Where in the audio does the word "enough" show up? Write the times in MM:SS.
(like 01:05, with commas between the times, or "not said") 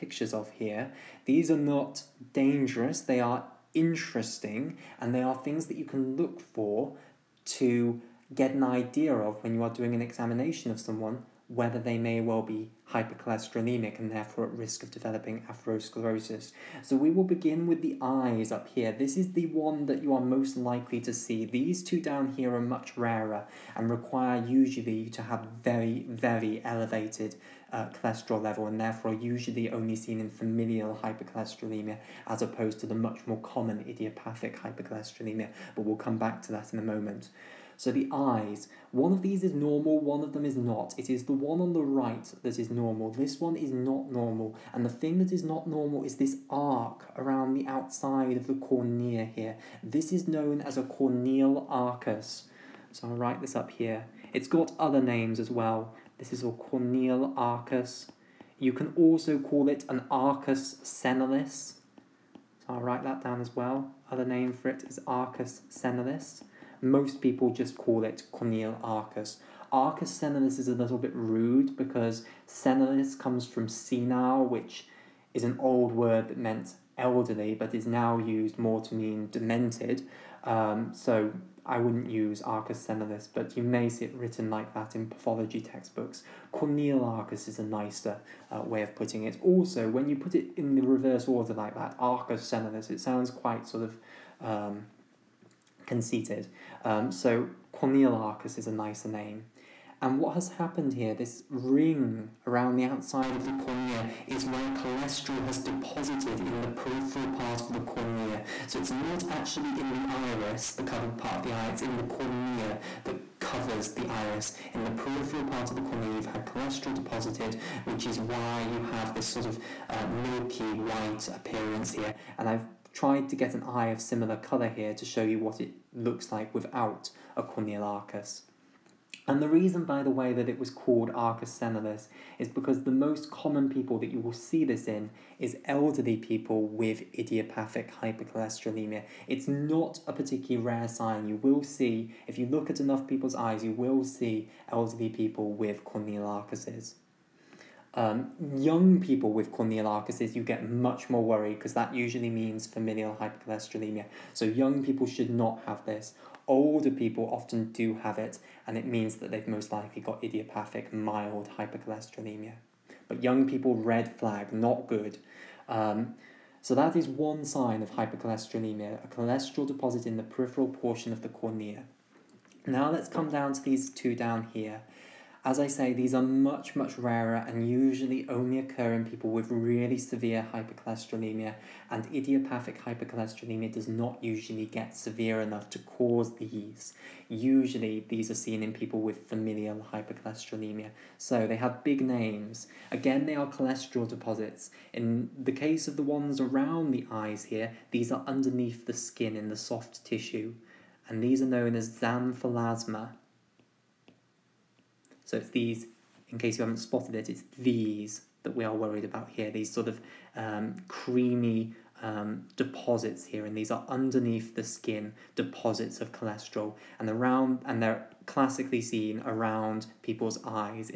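02:22, 03:05.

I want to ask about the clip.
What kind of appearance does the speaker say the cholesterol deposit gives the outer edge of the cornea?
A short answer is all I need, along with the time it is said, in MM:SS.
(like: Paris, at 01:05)
Milky white, at 02:00.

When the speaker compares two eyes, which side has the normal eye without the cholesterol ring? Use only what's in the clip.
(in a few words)
The right.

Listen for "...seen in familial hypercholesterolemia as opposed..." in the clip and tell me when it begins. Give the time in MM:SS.
00:29.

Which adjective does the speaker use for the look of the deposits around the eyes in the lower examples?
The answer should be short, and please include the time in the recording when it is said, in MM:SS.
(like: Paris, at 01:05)
Creamy, at 03:30.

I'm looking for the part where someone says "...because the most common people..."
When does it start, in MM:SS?
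02:12.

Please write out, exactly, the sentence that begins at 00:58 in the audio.
You can also call it an arcus senilis.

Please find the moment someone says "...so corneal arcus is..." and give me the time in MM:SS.
01:37.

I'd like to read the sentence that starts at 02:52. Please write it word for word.
Now let's come down to these two down here.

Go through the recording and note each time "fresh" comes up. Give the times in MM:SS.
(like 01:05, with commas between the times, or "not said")
not said.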